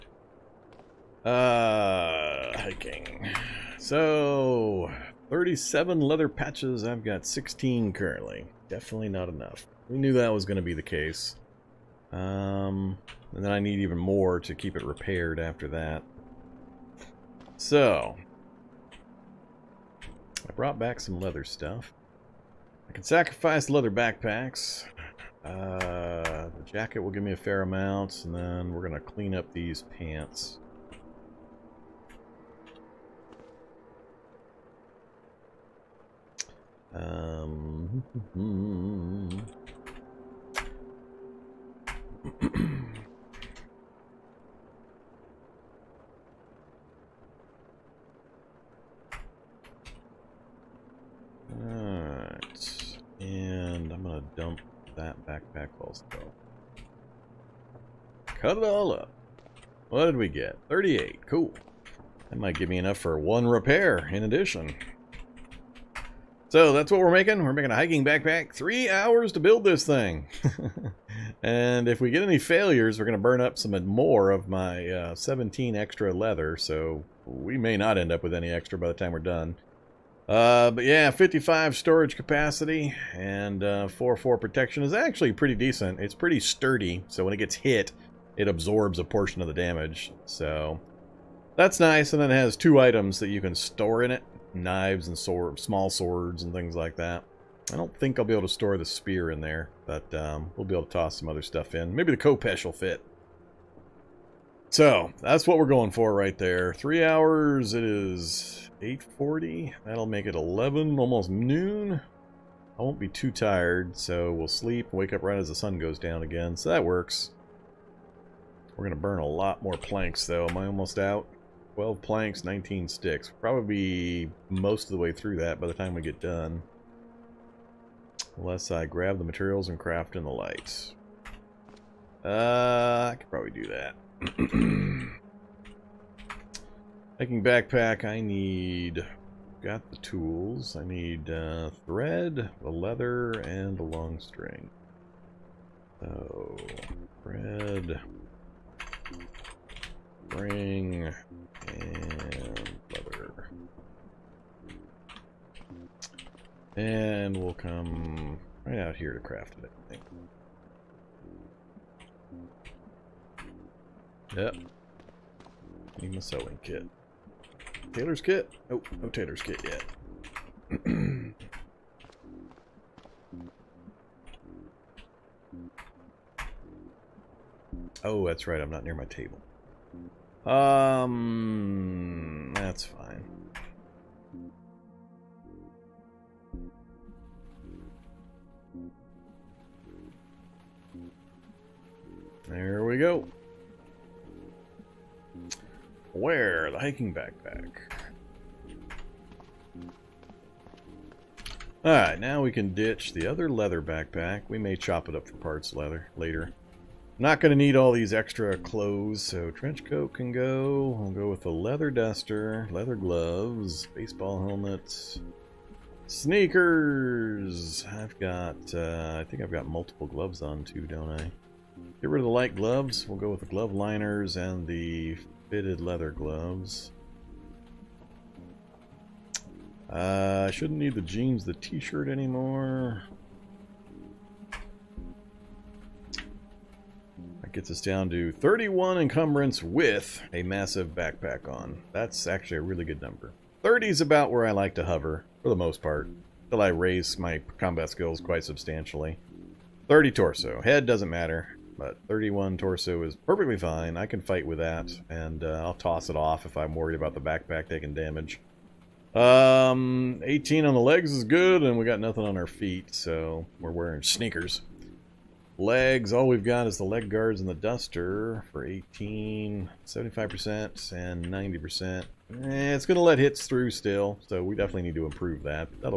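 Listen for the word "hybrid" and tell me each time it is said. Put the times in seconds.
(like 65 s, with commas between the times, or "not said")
not said.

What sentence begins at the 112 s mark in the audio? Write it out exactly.
I won't be too tired, so we'll sleep, wake up right as the sun goes down again, so that works.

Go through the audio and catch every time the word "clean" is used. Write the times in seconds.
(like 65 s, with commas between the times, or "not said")
28 s.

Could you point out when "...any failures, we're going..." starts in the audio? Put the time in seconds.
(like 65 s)
72 s.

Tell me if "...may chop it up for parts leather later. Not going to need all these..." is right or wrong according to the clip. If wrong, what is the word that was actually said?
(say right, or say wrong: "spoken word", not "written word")
right.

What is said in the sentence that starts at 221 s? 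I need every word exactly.
Get rid of the light gloves.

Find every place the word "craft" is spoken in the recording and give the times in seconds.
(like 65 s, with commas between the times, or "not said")
129 s, 159 s.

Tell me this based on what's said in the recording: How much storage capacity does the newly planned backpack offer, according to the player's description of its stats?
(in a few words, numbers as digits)
55.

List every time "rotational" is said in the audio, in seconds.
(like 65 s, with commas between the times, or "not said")
not said.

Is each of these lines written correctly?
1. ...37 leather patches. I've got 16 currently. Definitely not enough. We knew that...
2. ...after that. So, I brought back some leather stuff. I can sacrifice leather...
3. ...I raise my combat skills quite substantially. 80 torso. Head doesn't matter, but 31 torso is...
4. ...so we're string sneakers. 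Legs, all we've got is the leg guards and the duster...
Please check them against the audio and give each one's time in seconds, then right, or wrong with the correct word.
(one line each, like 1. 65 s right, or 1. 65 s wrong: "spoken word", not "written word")
1. 5 s right
2. 15 s right
3. 246 s wrong: "30", not "80"
4. 262 s wrong: "wearing", not "string".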